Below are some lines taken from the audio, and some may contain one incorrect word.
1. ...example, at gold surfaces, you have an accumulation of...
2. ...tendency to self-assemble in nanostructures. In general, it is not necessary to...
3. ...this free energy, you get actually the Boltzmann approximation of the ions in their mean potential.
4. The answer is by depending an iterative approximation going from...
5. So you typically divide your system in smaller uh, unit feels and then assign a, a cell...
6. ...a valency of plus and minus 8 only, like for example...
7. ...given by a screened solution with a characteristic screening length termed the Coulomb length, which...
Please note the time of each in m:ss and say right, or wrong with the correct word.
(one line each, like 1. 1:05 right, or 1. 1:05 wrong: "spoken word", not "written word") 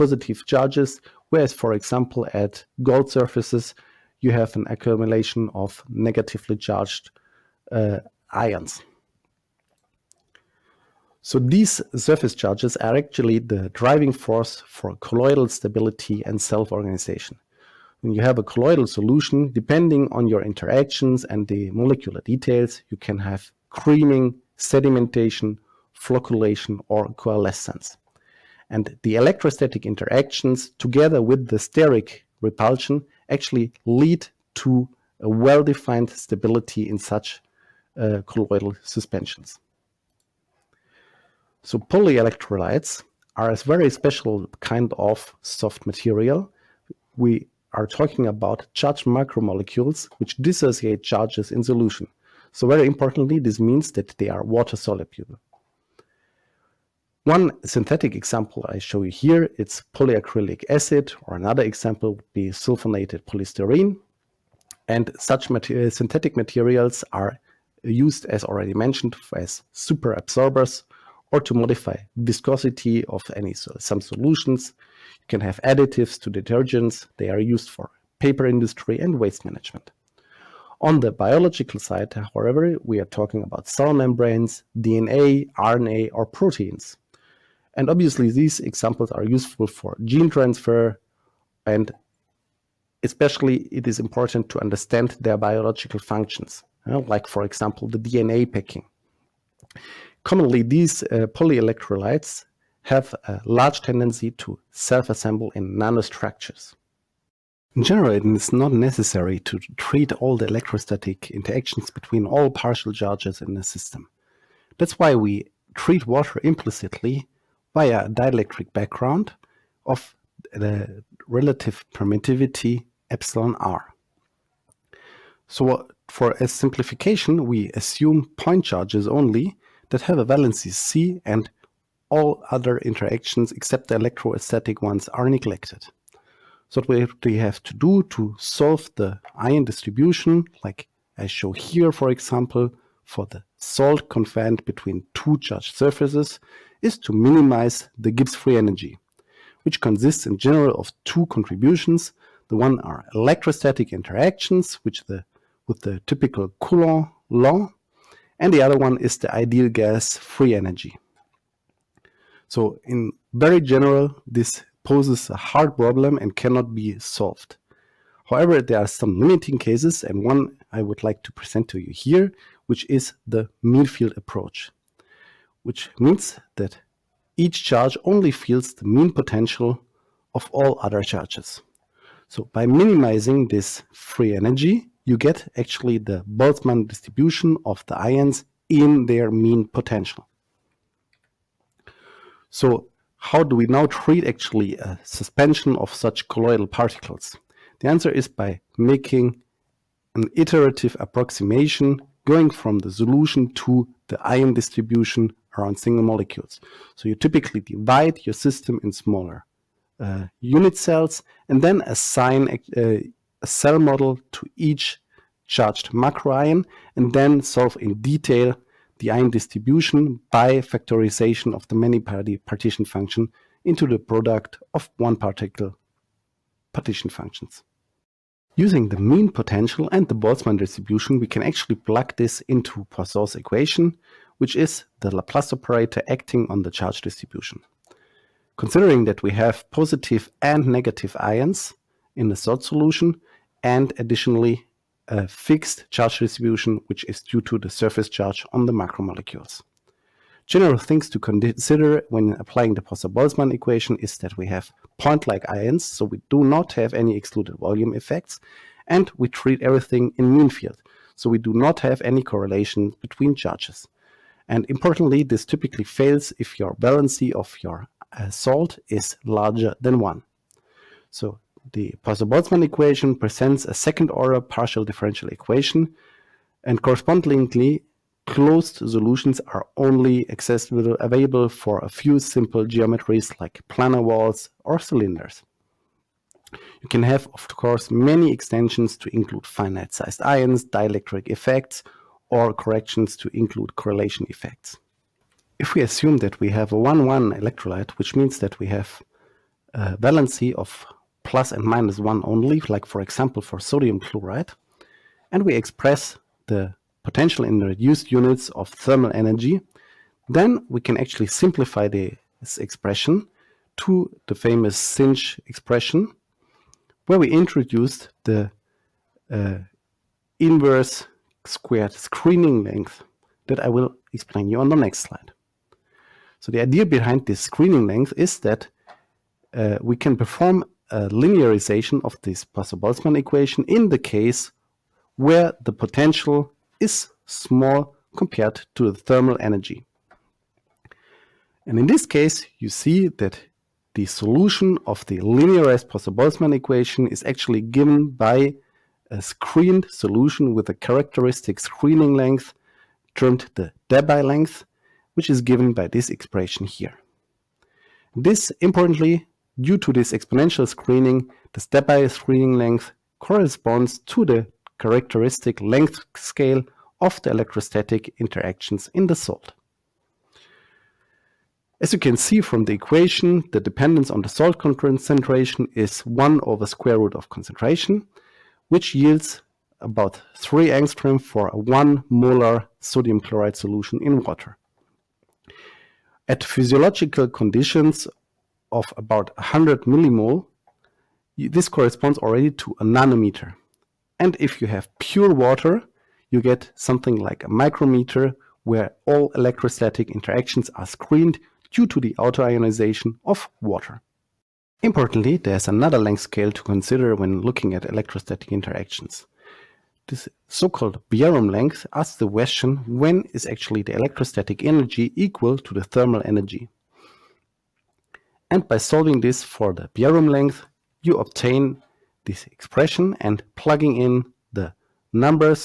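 1. 0:01 right
2. 1:43 right
3. 3:03 wrong: "distribution", not "approximation"
4. 3:17 wrong: "making", not "depending"
5. 3:26 wrong: "cells", not "feels"
6. 4:59 wrong: "1", not "8"
7. 5:47 wrong: "Debye", not "Coulomb".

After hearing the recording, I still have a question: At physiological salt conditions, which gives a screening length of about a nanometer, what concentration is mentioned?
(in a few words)
100 millimole.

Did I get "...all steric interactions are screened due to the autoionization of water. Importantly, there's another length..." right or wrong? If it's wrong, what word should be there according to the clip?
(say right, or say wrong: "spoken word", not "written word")
wrong: "electrostatic", not "steric".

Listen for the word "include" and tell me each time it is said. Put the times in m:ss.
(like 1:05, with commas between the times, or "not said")
4:49, 4:53.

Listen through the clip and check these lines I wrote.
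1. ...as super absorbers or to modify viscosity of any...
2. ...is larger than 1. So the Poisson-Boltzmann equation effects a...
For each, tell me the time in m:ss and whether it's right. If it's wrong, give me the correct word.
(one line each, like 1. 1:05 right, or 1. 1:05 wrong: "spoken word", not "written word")
1. 1:09 right
2. 4:28 wrong: "presents", not "effects".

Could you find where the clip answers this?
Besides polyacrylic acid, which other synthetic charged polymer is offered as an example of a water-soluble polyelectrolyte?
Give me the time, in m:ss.
1:02.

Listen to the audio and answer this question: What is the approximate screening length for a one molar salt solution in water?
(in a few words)
3 angstrom.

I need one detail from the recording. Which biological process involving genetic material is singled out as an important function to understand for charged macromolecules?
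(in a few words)
DNA packing.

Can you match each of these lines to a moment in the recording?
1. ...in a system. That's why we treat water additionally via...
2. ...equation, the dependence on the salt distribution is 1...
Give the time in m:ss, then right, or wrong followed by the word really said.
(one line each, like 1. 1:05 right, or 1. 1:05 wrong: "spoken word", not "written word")
1. 1:53 wrong: "implicitly", not "additionally"
2. 6:12 wrong: "concentration", not "distribution".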